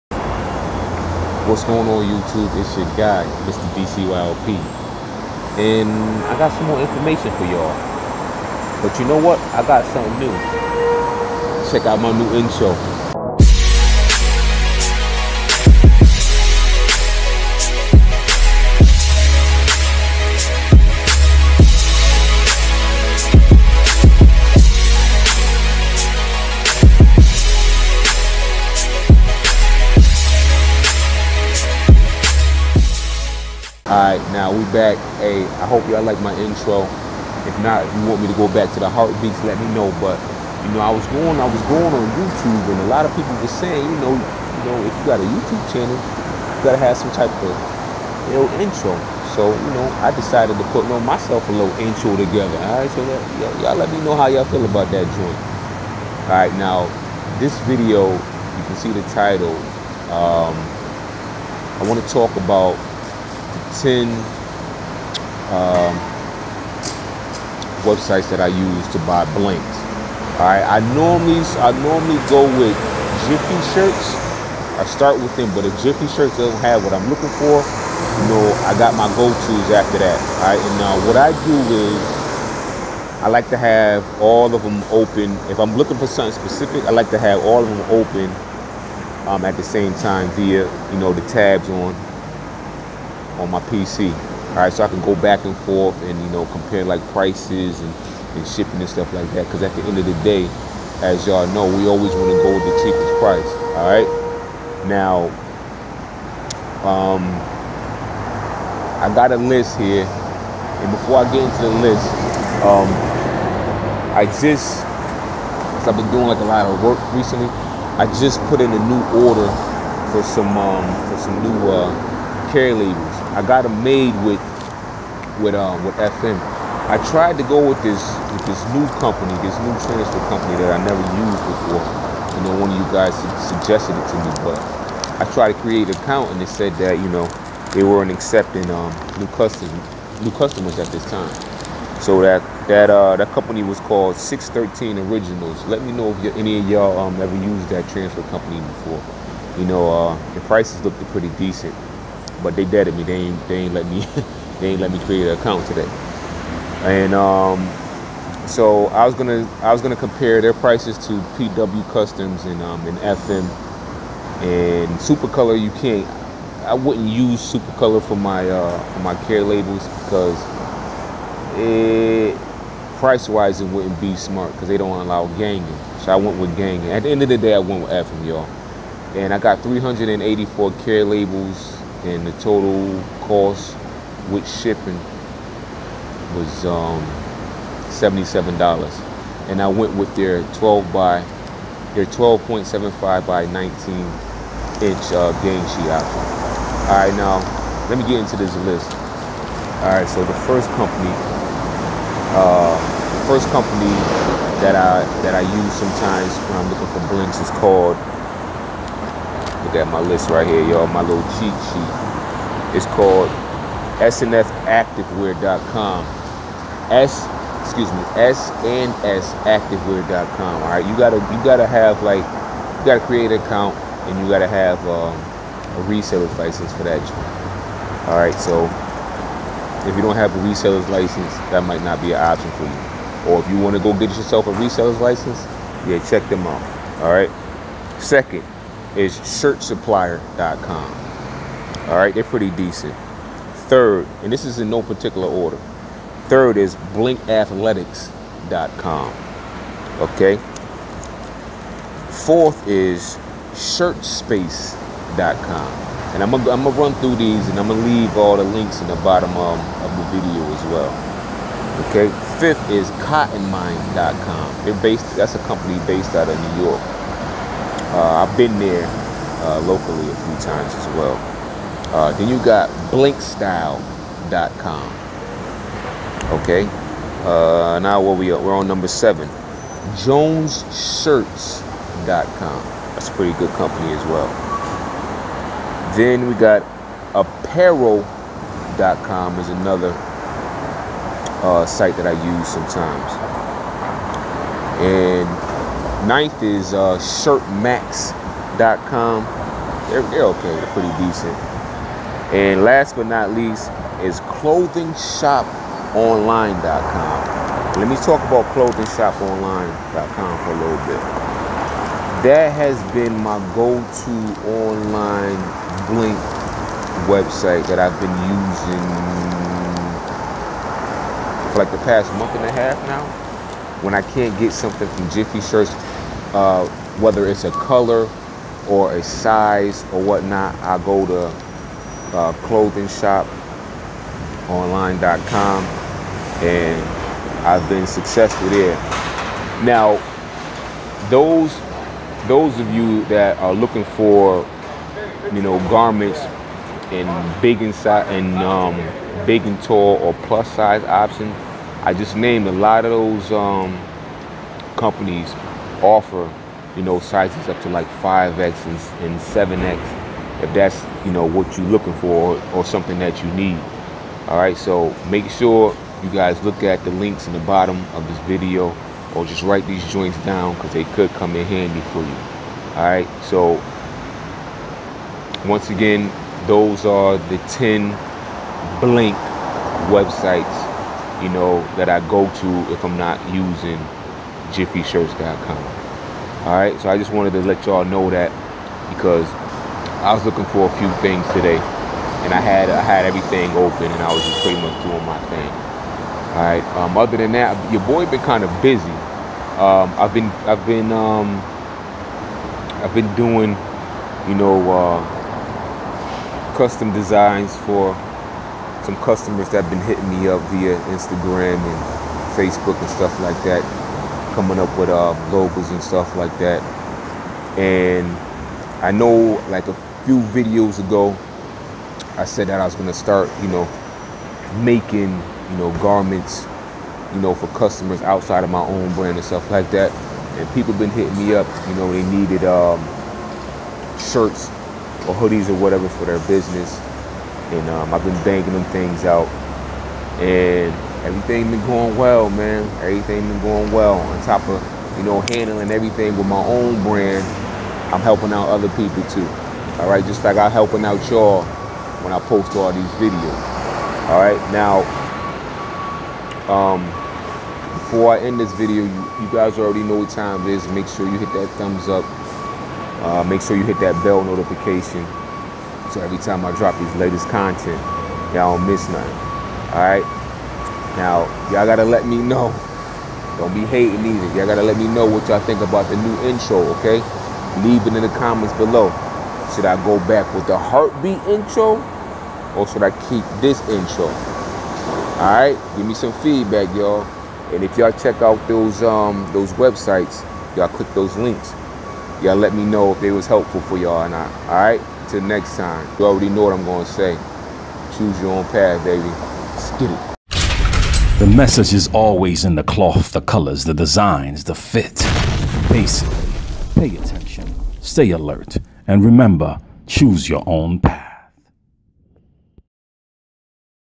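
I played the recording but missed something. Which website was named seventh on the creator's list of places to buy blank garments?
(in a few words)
JonesTShirts.com.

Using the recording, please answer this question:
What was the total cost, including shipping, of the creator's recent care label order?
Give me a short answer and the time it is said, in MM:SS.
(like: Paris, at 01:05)
$77, at 03:07.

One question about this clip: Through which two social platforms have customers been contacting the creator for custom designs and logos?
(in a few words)
Instagram and Facebook.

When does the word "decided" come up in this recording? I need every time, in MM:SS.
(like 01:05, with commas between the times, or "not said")
00:50.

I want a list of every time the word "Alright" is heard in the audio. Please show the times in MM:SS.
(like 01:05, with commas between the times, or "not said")
08:05, 08:14.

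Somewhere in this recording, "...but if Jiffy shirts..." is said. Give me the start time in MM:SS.
01:15.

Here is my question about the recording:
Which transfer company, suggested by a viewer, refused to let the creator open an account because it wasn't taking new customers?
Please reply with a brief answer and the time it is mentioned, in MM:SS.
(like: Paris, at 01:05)
613 Originals, at 02:24.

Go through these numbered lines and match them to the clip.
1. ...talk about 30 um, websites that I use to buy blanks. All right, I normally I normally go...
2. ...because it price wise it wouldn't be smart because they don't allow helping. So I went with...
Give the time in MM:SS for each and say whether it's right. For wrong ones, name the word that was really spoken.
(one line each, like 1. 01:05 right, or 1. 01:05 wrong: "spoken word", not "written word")
1. 01:02 wrong: "10", not "30"
2. 02:50 wrong: "ganging", not "helping".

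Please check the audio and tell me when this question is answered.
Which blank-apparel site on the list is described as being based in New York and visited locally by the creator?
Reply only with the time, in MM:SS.
04:23.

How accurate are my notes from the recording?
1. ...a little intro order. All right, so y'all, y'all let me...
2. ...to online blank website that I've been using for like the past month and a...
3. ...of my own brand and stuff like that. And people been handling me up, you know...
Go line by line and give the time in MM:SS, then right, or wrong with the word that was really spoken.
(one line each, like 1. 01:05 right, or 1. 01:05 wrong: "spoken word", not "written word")
1. 00:51 wrong: "together", not "order"
2. 05:13 right
3. 07:08 wrong: "hitting", not "handling".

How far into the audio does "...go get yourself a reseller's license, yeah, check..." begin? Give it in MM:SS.
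03:53.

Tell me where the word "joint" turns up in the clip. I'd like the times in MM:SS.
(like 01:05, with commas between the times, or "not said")
00:55, 06:09.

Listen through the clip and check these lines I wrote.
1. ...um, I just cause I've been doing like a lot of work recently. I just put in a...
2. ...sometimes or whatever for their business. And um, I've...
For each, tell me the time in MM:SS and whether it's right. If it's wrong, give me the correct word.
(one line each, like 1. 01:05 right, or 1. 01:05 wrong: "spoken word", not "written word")
1. 01:52 right
2. 07:15 wrong: "hoodies", not "sometimes".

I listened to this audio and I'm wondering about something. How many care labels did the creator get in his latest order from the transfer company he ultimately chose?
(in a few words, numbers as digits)
384.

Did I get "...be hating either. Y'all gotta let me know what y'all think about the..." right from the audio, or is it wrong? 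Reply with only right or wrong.
right.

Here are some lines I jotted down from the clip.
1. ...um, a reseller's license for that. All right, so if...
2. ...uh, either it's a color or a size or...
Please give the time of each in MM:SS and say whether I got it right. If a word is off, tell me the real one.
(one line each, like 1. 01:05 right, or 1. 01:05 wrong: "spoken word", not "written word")
1. 03:44 right
2. 05:26 wrong: "whether", not "either".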